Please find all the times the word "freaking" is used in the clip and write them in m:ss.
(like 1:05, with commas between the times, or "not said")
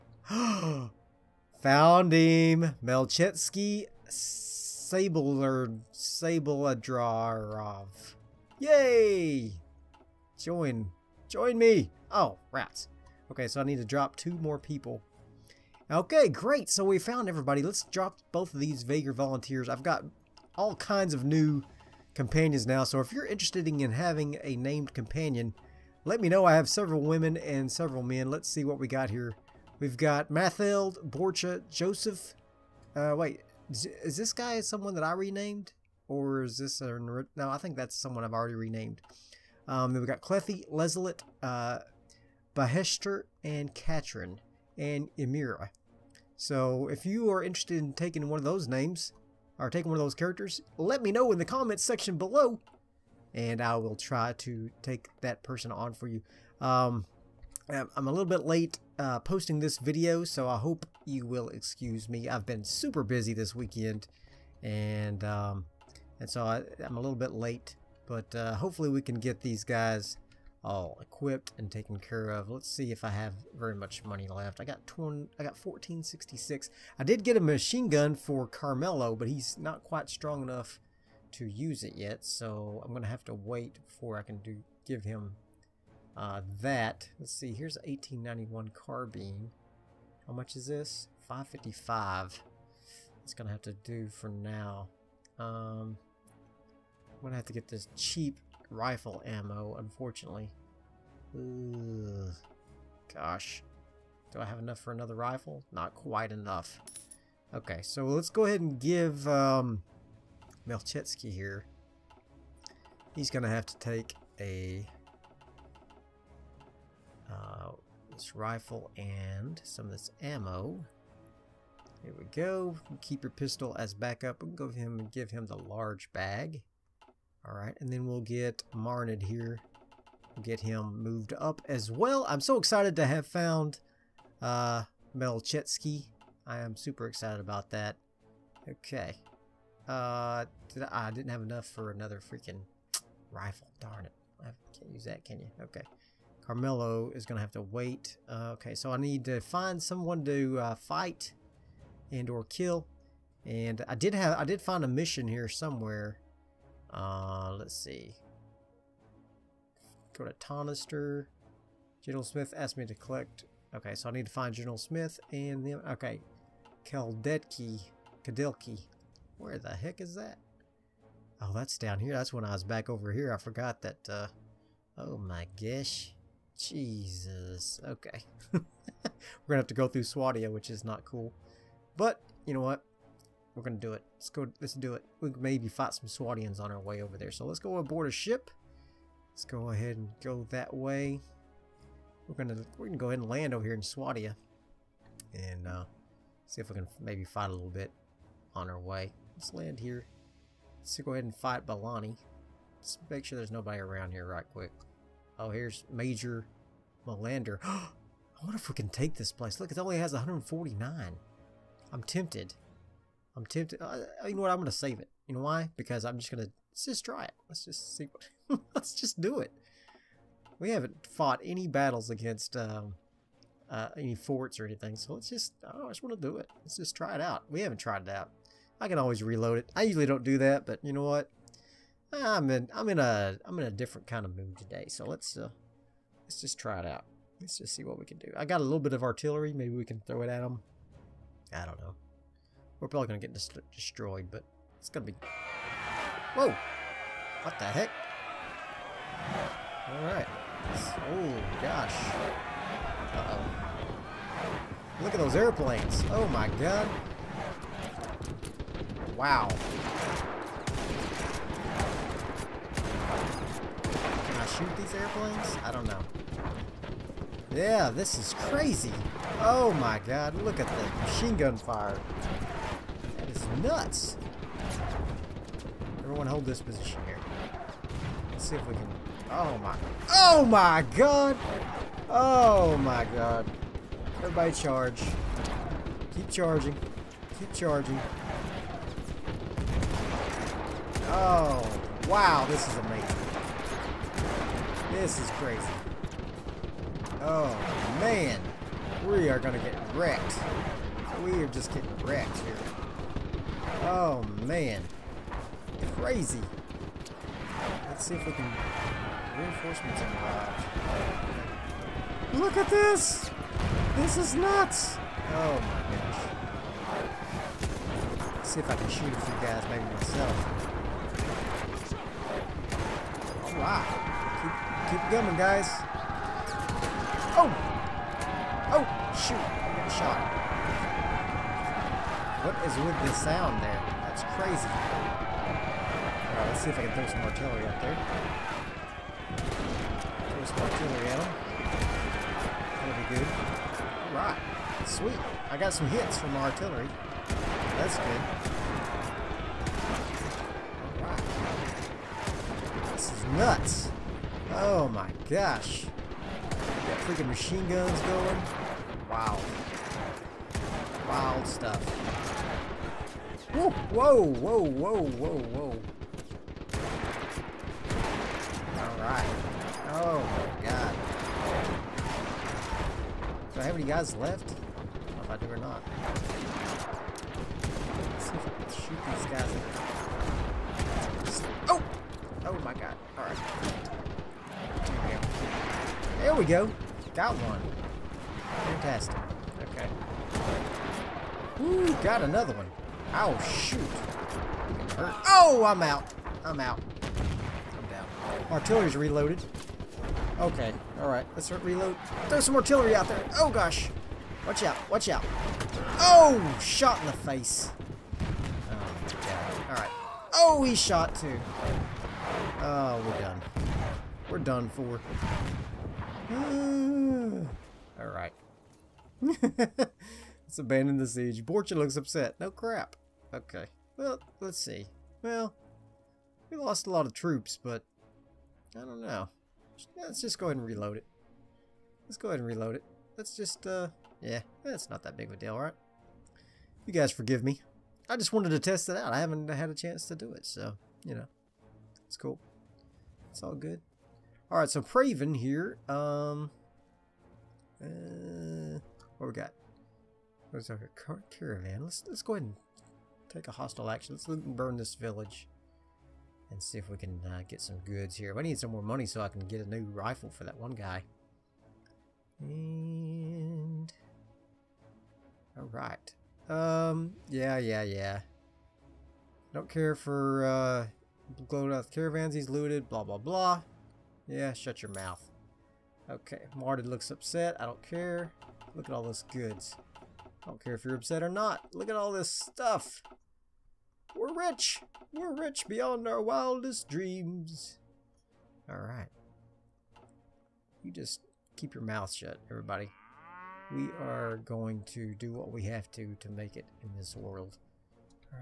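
2:22, 5:57.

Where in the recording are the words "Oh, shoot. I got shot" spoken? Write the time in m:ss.
5:28.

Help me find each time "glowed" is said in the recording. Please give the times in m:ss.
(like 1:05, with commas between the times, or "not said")
7:51.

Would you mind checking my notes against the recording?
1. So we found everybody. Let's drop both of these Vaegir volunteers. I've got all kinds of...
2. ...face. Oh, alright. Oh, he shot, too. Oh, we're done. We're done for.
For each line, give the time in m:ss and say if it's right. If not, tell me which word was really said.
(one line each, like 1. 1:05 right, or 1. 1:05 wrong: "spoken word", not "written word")
1. 0:16 right
2. 6:47 right.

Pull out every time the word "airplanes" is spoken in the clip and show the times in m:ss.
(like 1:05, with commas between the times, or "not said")
4:15, 4:24.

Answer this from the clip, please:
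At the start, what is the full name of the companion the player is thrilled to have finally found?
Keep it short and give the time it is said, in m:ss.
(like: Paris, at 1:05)
Melchetsky Sabler Sabladrov, at 0:02.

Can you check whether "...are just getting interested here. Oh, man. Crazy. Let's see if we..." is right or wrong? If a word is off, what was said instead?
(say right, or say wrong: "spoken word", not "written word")
wrong: "wrecked", not "interested".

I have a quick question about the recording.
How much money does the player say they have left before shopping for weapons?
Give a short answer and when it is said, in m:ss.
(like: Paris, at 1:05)
1466, at 1:15.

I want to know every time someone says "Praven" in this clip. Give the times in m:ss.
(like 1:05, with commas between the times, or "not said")
7:24.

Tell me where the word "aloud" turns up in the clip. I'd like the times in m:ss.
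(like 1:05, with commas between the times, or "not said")
not said.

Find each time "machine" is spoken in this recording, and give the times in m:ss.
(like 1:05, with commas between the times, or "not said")
1:17, 4:31, 5:57.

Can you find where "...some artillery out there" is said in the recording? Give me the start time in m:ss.
6:42.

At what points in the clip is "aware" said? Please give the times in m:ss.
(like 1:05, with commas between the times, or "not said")
not said.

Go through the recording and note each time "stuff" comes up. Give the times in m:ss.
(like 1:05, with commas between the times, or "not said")
6:01, 8:02.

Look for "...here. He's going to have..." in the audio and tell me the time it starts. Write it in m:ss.
1:51.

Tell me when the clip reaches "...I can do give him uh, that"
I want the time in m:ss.
1:24.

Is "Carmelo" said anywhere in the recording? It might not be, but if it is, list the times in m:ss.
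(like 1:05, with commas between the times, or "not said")
1:18, 2:26.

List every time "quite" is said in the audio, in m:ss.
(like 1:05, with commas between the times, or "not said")
1:19, 1:45.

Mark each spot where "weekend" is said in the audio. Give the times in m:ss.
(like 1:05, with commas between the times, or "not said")
1:03.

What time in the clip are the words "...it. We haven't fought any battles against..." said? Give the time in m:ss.
3:39.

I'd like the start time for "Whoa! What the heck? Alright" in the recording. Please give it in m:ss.
4:06.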